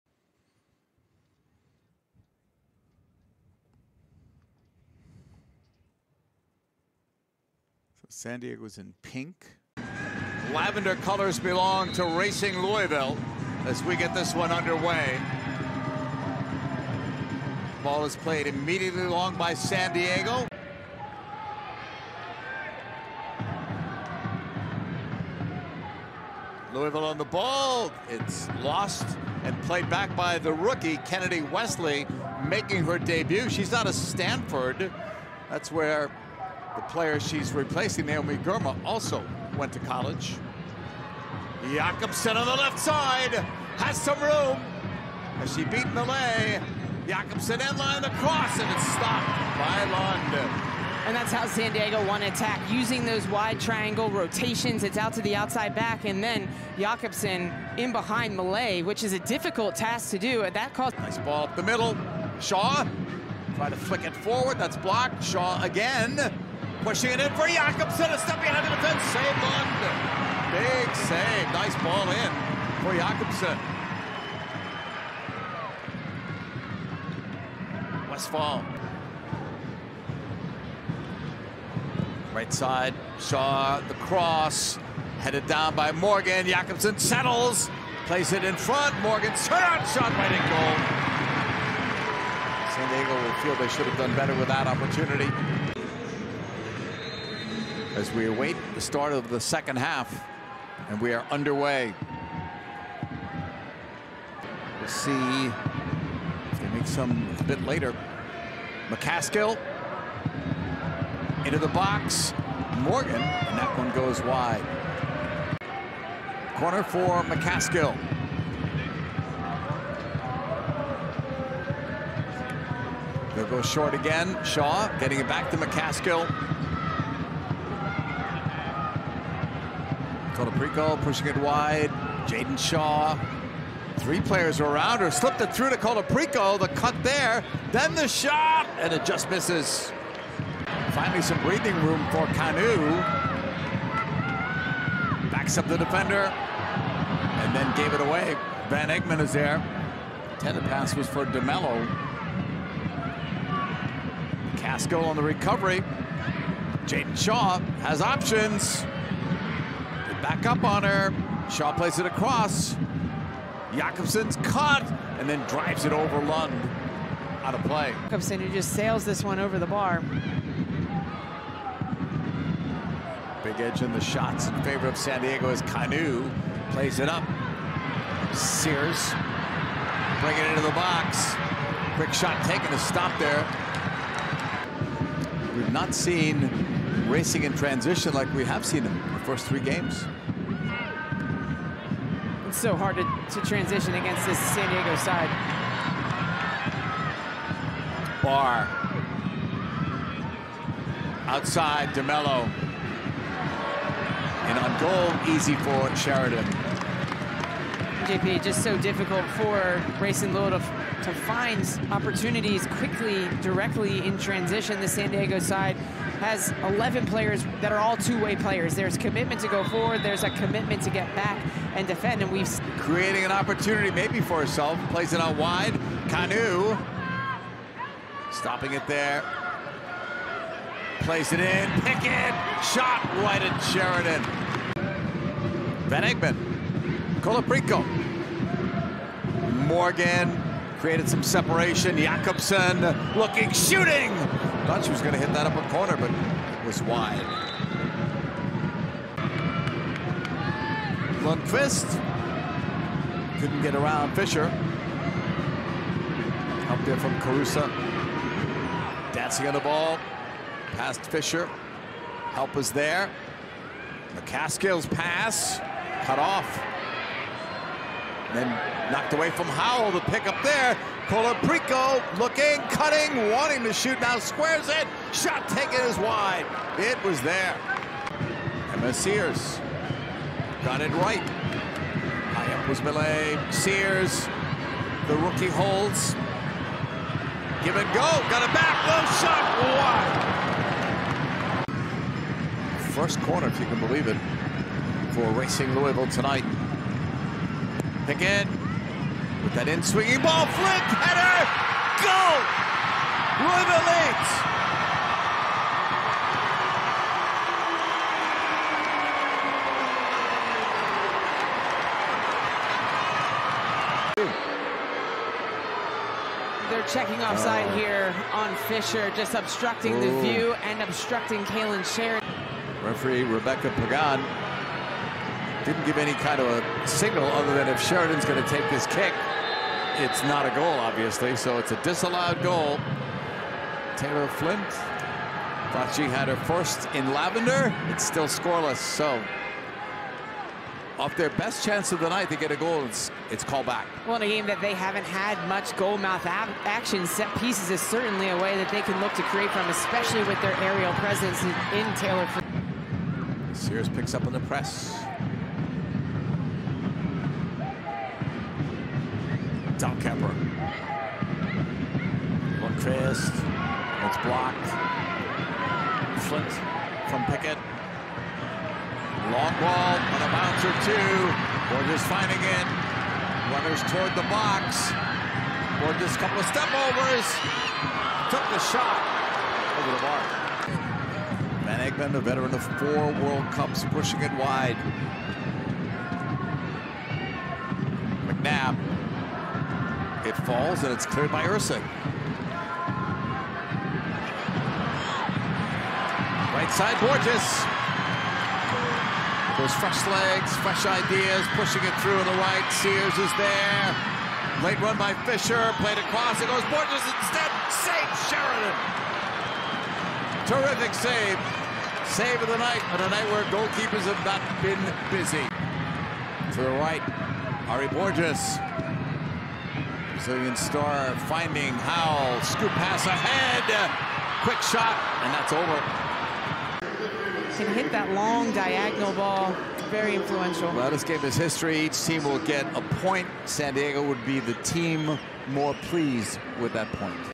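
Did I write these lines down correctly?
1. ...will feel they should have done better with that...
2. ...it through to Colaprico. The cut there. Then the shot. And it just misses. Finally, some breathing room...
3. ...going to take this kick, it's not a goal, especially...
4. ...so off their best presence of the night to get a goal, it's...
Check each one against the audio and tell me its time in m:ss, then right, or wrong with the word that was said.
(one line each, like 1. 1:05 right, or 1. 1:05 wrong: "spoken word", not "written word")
1. 1:33 right
2. 2:15 right
3. 5:28 wrong: "obviously", not "especially"
4. 5:38 wrong: "chance", not "presence".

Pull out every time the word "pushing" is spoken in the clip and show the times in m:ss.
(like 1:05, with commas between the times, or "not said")
1:06, 2:11, 6:23, 6:41.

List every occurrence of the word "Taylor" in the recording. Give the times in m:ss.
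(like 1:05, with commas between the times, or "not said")
5:33, 5:51.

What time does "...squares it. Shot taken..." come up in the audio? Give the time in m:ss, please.
4:34.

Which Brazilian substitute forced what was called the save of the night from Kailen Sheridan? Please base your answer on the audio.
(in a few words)
Ary Borges.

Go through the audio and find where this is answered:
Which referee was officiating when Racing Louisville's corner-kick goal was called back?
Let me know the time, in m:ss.
5:23.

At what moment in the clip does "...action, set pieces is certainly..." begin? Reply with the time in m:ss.
5:46.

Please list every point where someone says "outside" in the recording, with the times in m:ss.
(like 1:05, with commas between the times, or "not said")
0:55, 3:21.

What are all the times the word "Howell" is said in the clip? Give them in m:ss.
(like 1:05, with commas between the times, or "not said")
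4:29, 7:01.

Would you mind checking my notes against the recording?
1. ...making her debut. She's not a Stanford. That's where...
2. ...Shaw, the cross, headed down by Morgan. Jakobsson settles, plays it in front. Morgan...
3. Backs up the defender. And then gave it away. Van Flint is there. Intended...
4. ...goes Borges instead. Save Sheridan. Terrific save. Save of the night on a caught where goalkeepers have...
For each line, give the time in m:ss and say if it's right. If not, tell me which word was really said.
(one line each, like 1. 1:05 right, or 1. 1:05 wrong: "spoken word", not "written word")
1. 0:32 right
2. 1:23 right
3. 2:25 wrong: "Egmond", not "Flint"
4. 6:46 wrong: "night", not "caught".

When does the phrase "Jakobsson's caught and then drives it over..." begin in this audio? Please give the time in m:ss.
2:43.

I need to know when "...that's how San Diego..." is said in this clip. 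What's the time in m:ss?
0:51.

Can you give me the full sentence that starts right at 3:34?
The San Diego side has 11 players that are all two-way players.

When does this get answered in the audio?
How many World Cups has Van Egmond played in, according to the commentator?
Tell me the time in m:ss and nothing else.
6:22.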